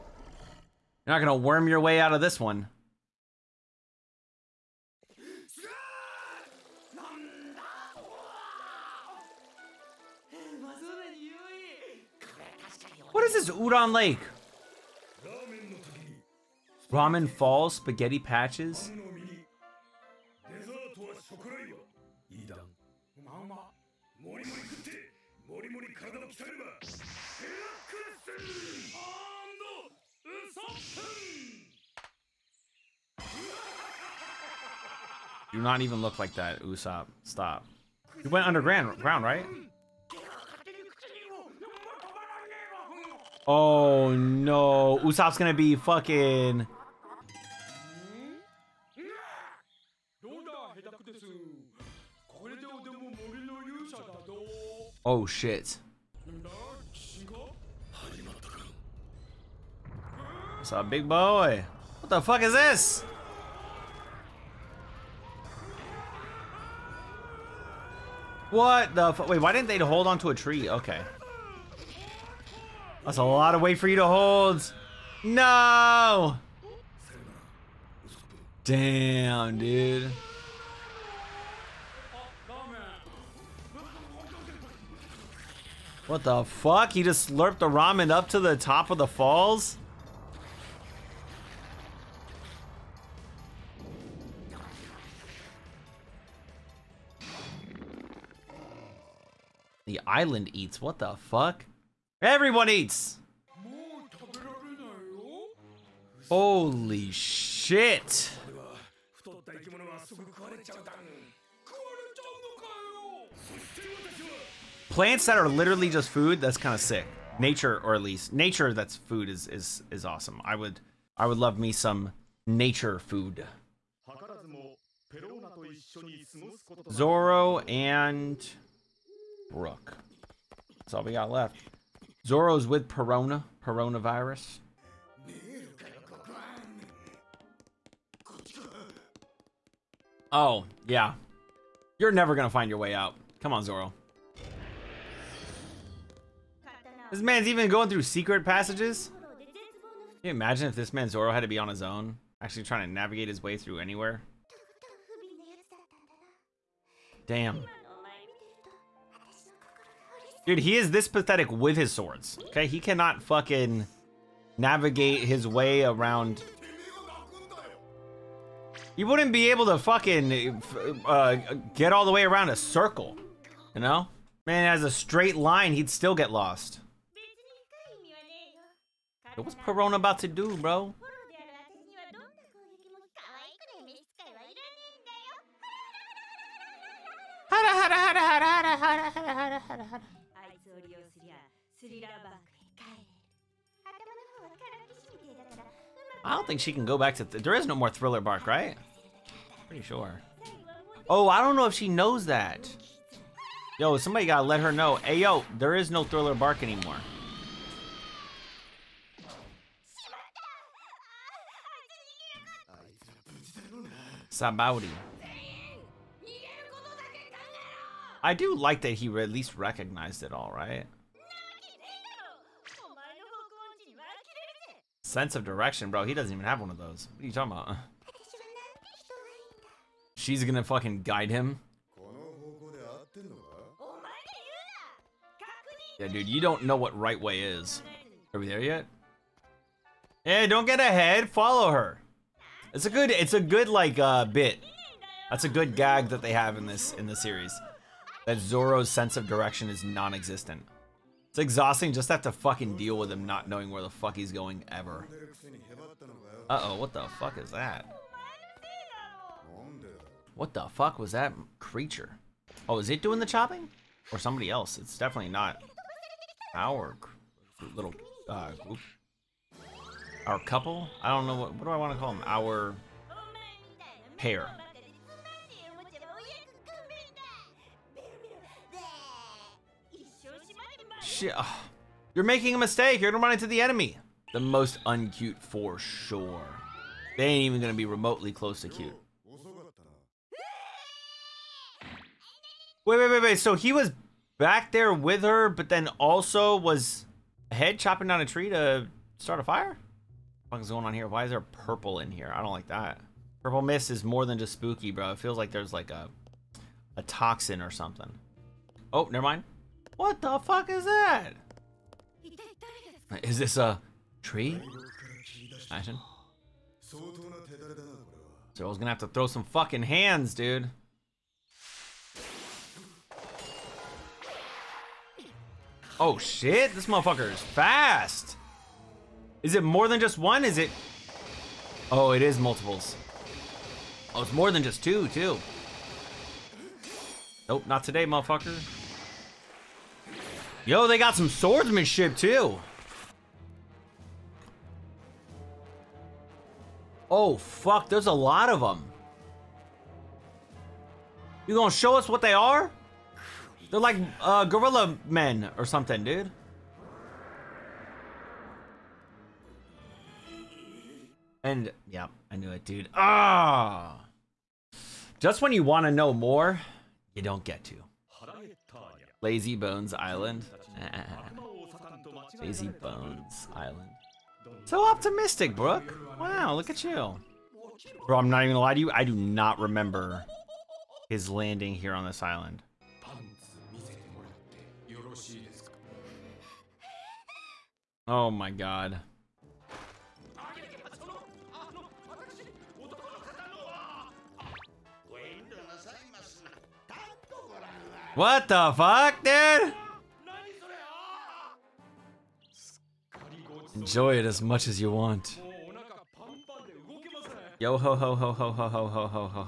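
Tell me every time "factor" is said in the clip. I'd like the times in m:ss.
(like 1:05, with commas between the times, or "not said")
not said.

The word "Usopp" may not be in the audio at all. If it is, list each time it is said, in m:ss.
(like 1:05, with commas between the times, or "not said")
0:36, 0:45.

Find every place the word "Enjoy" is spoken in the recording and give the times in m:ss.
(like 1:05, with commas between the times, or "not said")
6:43.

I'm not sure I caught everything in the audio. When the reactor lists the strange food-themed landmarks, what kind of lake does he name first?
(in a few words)
Udon Lake.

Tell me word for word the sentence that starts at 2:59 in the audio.
what's Perona about to do, bro?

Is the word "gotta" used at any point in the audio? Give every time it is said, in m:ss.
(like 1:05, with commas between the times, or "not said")
3:24.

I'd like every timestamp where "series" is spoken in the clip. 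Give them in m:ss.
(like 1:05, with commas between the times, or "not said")
4:07.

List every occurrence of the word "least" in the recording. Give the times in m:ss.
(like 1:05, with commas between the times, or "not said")
1:58, 3:39.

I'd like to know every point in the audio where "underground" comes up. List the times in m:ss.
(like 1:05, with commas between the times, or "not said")
0:38.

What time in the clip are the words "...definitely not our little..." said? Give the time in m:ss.
4:24.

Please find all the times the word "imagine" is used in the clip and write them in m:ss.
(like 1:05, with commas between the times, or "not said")
2:30, 5:15.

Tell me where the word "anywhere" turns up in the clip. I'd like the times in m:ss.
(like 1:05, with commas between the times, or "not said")
2:33.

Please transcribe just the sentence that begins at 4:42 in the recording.
You're gonna run into the enemy.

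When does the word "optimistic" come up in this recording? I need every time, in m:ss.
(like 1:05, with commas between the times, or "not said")
6:14.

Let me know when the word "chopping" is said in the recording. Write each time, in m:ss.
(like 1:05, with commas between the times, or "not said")
4:23, 4:57.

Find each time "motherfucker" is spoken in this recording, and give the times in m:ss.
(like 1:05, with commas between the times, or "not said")
5:26, 5:38.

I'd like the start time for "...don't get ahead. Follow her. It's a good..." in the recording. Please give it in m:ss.
4:00.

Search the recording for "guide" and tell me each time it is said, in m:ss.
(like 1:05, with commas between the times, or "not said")
3:51.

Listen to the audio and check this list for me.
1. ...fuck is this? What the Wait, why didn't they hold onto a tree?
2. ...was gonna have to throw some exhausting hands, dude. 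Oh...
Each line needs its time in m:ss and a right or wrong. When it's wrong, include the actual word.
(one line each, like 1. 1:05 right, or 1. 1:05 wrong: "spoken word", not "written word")
1. 1:02 right
2. 5:18 wrong: "fucking", not "exhausting".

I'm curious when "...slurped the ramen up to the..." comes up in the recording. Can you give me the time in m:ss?
1:27.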